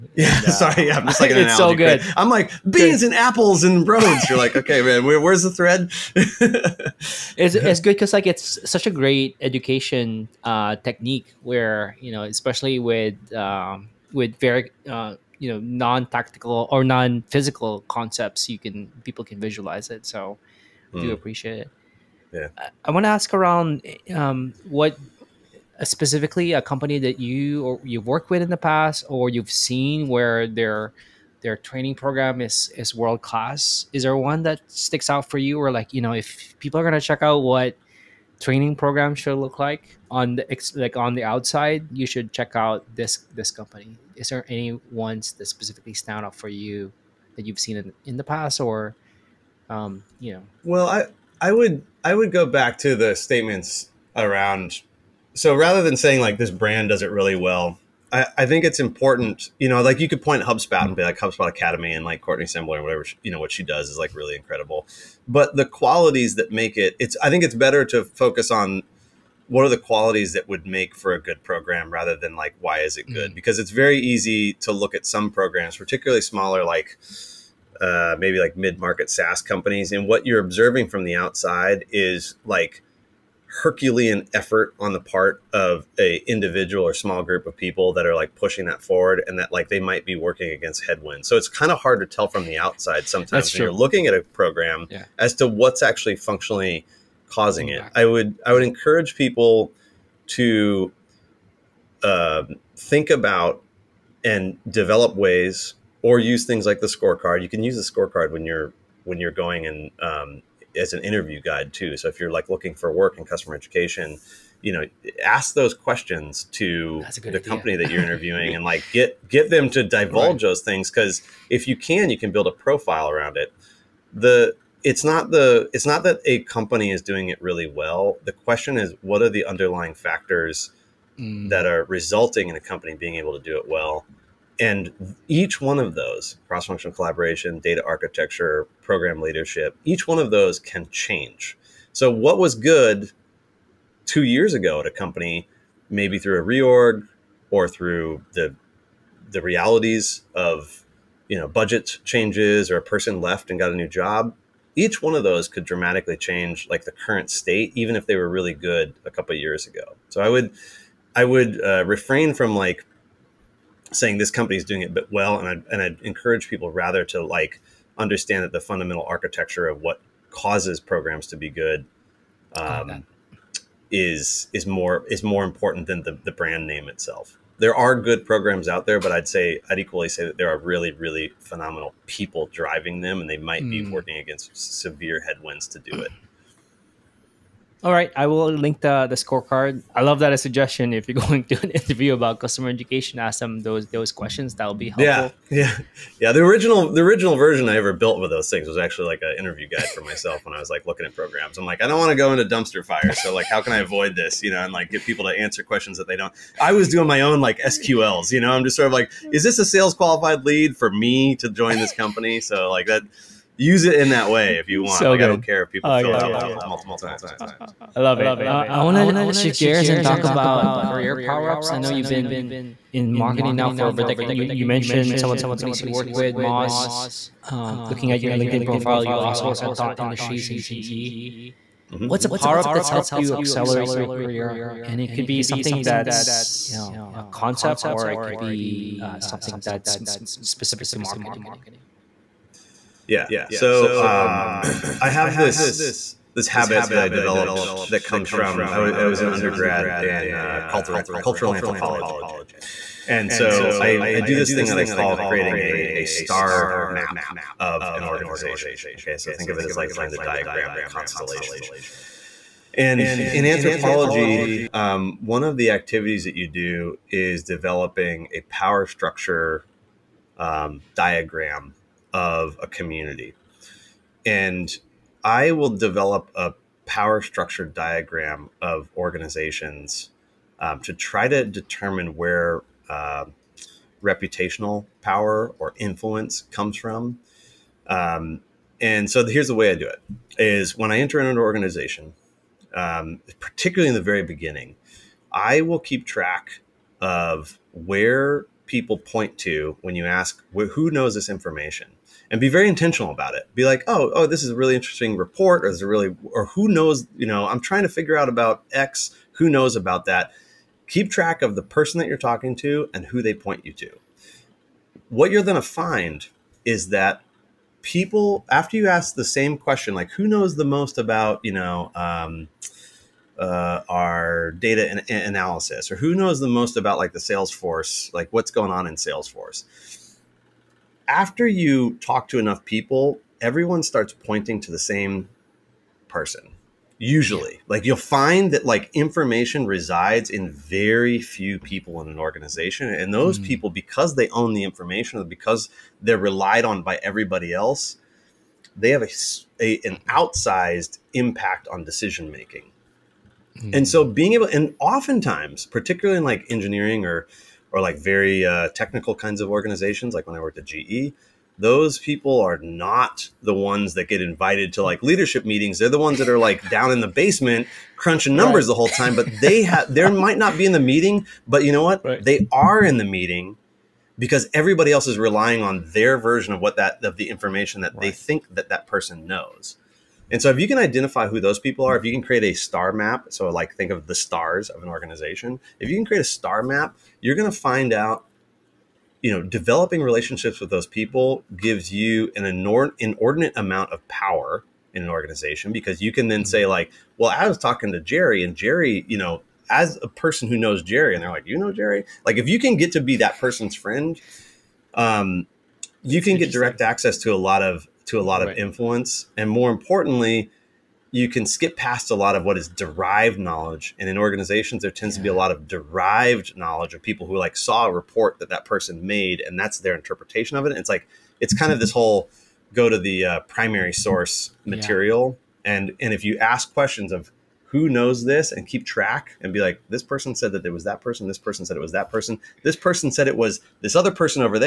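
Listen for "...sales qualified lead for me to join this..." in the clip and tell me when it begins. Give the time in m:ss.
3:29.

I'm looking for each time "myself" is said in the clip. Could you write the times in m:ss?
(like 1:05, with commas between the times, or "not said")
3:20.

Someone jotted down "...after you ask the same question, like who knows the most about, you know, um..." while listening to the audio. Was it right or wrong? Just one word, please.
right.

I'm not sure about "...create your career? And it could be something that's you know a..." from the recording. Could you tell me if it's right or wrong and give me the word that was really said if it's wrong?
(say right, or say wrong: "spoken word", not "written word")
wrong: "accelerate", not "create".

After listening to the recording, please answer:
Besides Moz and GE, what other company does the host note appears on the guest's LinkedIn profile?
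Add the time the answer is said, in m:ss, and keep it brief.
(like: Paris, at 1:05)
Thought Industries, at 3:49.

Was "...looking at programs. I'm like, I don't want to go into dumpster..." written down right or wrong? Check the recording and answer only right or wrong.
right.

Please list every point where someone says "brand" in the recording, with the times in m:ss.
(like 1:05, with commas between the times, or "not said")
0:56, 2:56.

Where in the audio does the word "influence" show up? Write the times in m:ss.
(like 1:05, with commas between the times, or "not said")
4:45, 6:48.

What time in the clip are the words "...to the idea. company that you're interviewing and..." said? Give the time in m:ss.
1:56.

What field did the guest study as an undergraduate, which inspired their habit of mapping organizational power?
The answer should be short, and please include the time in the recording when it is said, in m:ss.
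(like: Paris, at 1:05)
Cultural anthropology, at 4:10.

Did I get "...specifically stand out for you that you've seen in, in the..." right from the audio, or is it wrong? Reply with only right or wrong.
right.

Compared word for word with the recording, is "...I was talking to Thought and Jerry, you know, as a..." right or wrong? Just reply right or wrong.
wrong.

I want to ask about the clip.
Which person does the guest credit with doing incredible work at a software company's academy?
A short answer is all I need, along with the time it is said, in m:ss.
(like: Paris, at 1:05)
Courtney Sembler, at 1:02.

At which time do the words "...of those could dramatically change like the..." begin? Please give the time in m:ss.
2:35.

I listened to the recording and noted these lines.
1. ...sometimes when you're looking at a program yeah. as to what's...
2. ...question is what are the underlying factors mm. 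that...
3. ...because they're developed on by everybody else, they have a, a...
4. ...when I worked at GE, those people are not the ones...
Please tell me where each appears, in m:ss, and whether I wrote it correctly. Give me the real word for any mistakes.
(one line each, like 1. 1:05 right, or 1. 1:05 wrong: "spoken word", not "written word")
1. 1:33 right
2. 2:08 right
3. 5:45 wrong: "relied", not "developed"
4. 6:00 right.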